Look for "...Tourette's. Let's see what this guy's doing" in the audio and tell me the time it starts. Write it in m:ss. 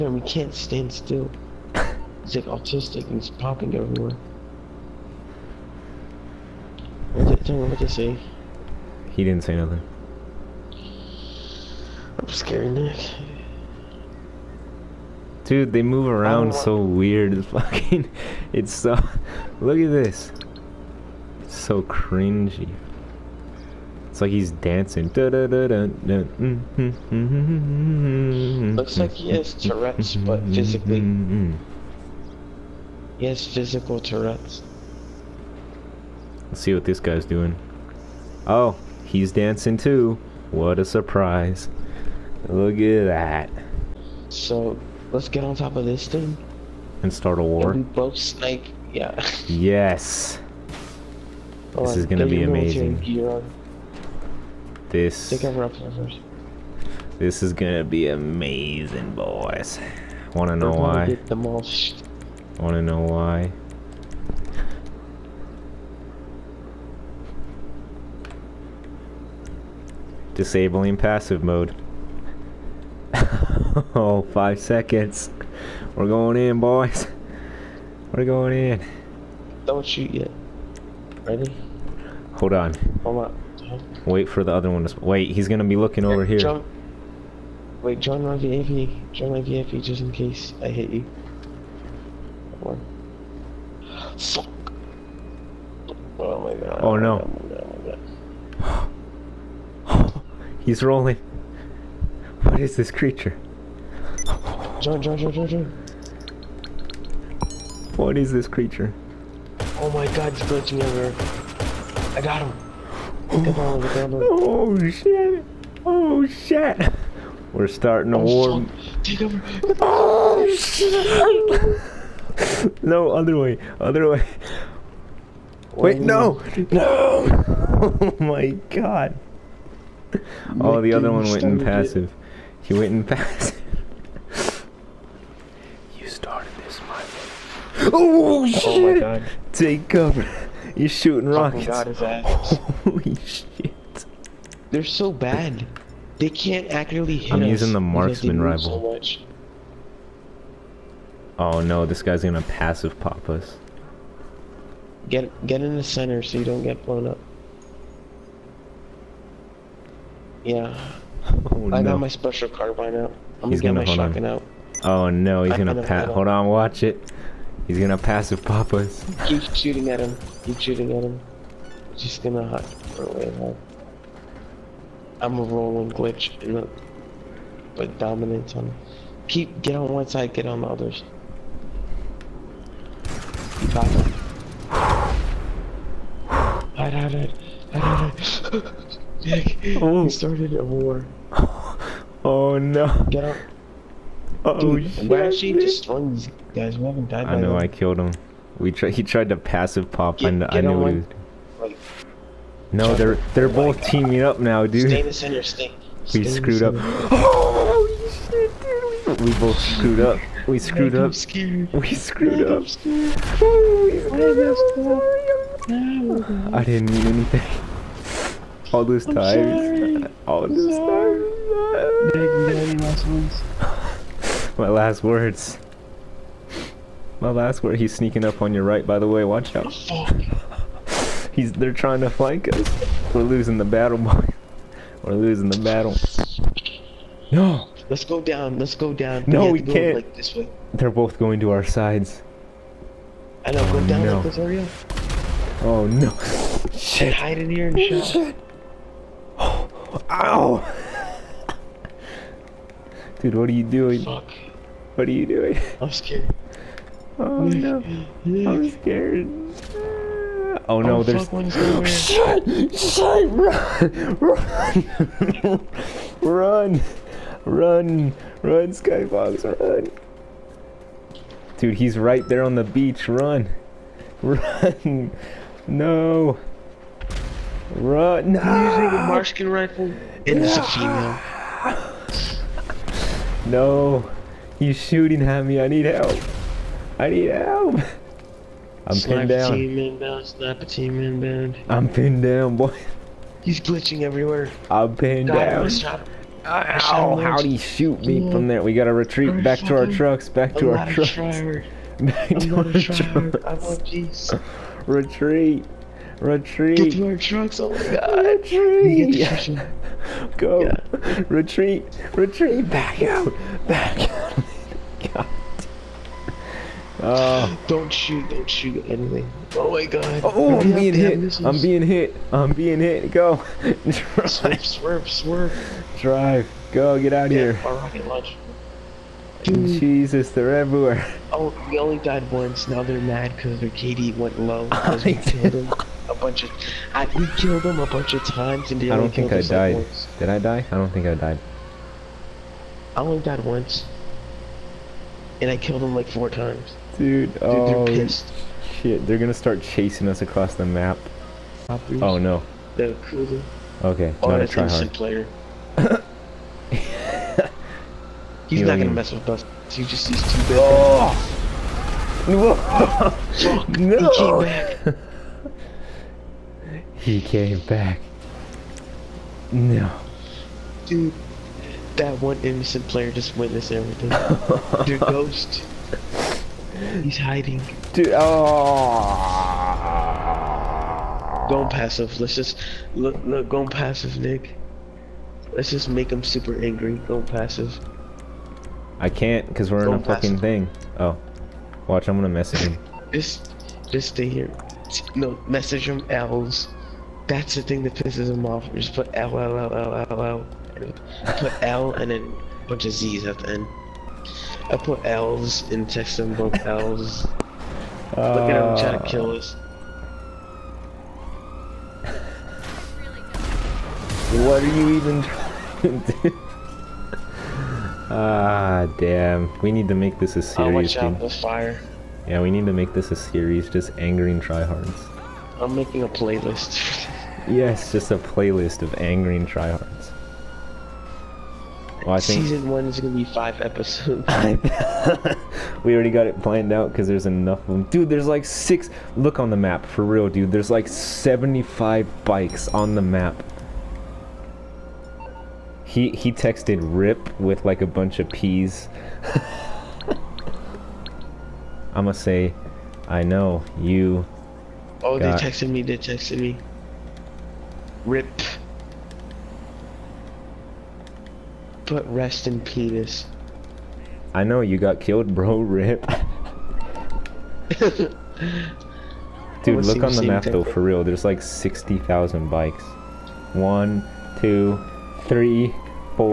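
0:34.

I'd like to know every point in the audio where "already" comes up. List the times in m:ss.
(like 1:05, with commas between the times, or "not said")
7:15.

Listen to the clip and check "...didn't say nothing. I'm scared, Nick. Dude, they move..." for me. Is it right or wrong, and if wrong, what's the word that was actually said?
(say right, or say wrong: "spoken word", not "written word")
right.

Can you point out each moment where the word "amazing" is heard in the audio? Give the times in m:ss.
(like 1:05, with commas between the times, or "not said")
0:52, 0:58.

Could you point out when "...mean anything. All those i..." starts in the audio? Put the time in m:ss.
3:36.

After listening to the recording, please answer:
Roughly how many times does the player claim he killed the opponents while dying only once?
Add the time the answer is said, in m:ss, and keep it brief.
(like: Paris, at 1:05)
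4, at 5:45.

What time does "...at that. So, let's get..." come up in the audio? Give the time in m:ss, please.
0:42.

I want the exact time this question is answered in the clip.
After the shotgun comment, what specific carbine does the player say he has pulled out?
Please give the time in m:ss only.
2:42.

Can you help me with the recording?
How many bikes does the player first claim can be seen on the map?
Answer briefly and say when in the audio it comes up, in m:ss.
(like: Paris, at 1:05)
75, at 7:20.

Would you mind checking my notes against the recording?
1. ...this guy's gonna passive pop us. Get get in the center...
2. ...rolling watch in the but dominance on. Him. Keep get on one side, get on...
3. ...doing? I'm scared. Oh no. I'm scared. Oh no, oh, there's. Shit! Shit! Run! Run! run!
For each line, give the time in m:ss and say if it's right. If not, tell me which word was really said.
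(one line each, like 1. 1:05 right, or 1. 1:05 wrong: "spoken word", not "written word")
1. 2:31 right
2. 2:55 wrong: "glitch", not "watch"
3. 4:15 right.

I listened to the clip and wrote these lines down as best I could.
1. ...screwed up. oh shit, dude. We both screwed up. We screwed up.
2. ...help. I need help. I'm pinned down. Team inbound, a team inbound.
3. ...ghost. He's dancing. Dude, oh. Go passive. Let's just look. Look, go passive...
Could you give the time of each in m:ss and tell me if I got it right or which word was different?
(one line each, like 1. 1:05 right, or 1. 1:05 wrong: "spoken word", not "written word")
1. 3:26 right
2. 4:45 right
3. 6:15 wrong: "hiding", not "dancing".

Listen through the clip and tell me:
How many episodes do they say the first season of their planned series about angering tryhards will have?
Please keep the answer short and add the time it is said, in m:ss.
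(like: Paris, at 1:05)
5, at 7:13.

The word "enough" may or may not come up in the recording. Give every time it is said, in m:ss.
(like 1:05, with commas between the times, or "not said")
7:17.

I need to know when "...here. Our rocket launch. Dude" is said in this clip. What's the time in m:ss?
5:27.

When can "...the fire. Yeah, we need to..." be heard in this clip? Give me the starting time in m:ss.
7:01.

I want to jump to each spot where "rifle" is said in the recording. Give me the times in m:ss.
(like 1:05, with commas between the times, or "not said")
2:28, 4:39.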